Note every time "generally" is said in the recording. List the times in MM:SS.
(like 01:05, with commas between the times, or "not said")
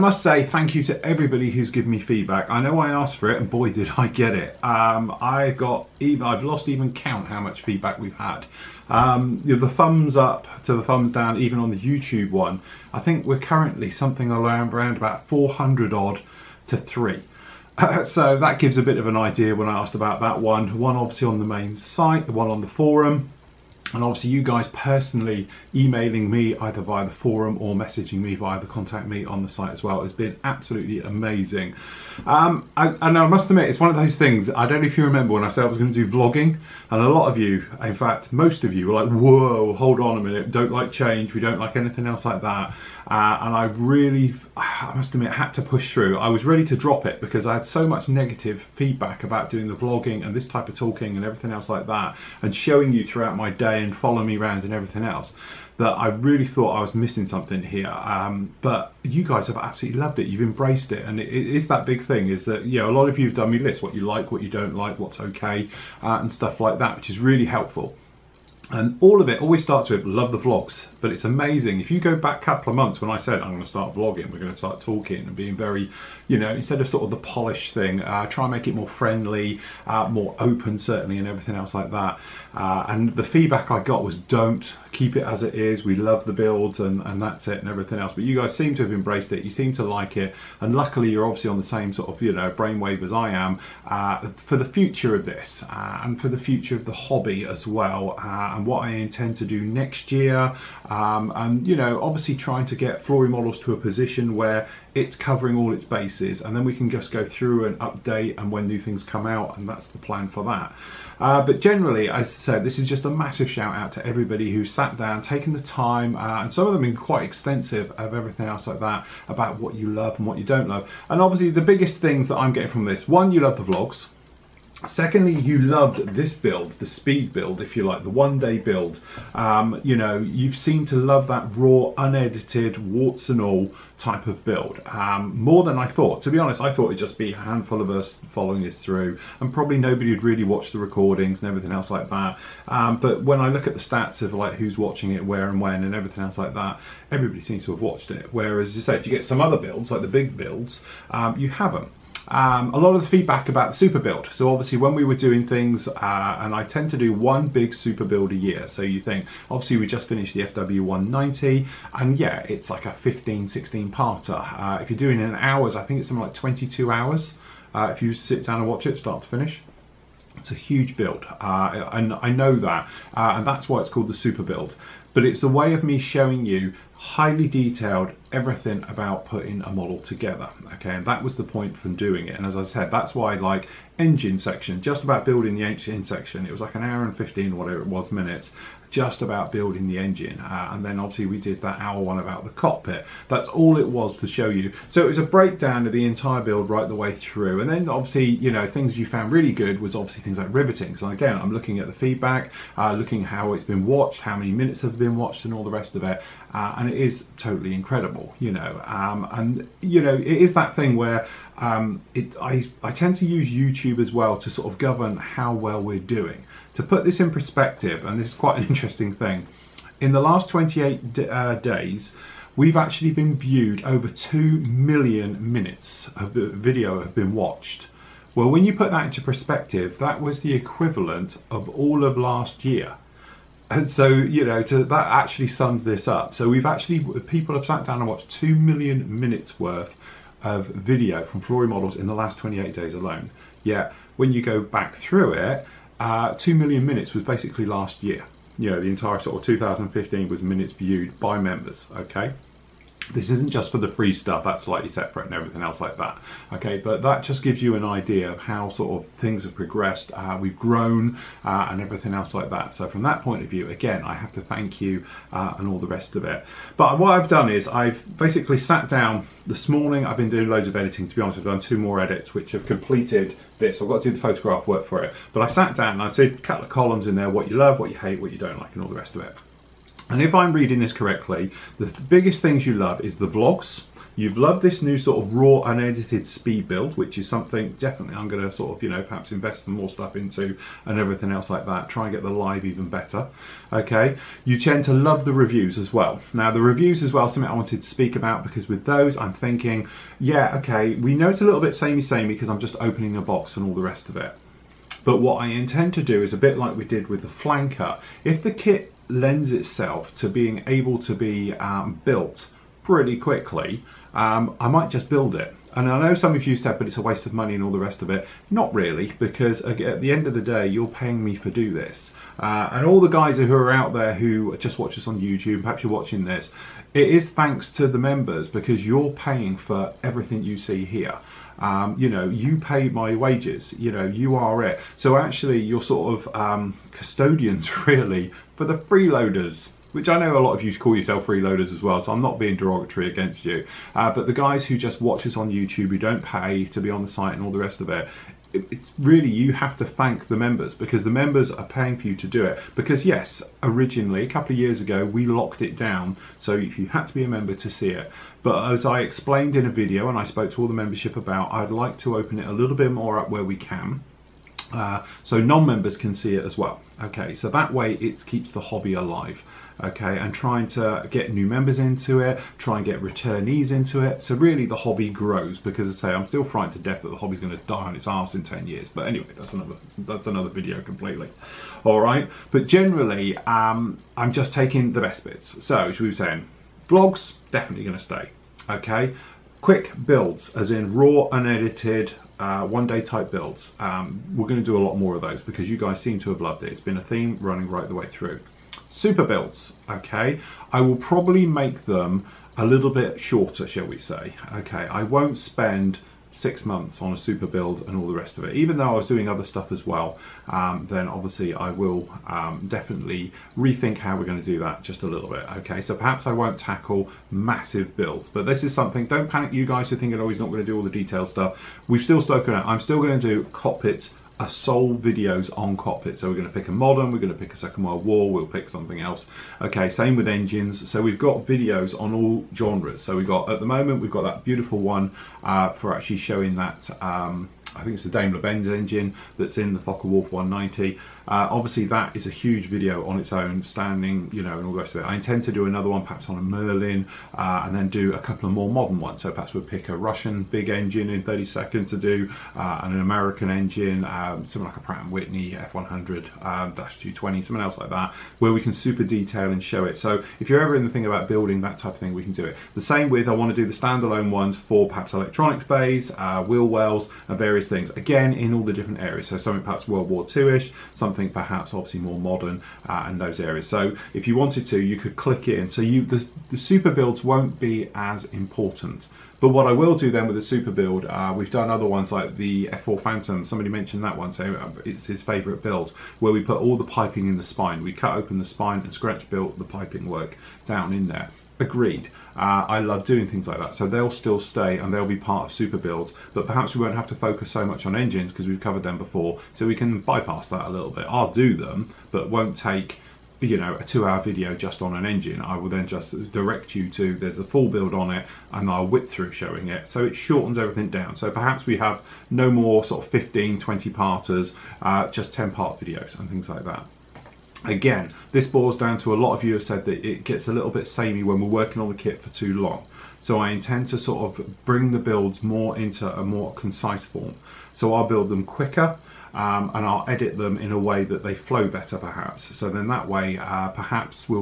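01:51, 06:22.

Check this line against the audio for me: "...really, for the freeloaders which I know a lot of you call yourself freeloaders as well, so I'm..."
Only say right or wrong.
right.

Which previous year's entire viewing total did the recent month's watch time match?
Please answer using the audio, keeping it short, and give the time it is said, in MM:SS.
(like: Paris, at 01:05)
2015, at 04:09.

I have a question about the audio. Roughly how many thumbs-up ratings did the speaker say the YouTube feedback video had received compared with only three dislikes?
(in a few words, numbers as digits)
400.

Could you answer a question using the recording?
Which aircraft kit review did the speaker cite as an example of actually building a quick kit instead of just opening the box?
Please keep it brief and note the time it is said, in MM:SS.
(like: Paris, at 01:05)
Flanker, at 05:07.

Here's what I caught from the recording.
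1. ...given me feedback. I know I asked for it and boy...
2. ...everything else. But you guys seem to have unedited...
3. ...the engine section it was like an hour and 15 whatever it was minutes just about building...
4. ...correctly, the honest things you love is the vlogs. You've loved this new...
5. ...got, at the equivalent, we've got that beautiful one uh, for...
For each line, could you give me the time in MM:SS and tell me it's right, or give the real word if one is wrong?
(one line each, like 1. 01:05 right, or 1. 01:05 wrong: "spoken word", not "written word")
1. 00:01 right
2. 01:27 wrong: "embraced", not "unedited"
3. 03:05 right
4. 04:40 wrong: "biggest", not "honest"
5. 07:13 wrong: "moment", not "equivalent".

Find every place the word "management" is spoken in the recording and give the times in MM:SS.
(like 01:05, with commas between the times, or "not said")
not said.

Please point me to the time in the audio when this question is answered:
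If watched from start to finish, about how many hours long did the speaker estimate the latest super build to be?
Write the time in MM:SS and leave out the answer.
02:46.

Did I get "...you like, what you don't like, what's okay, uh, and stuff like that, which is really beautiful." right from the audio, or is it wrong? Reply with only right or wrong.
wrong.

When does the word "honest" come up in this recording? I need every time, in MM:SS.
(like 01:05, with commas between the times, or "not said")
02:16, 04:31.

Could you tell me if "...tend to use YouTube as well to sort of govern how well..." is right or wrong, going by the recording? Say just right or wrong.
right.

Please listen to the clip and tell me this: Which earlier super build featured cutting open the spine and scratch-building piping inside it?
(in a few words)
F4 Phantom.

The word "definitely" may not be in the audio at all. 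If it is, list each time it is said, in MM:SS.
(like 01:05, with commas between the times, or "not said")
04:47, 06:27, 06:52.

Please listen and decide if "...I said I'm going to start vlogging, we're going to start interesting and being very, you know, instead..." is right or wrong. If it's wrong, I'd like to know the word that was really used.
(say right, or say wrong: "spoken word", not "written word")
wrong: "talking", not "interesting".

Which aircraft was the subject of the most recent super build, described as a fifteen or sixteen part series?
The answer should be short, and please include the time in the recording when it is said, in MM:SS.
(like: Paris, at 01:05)
FW190, at 02:40.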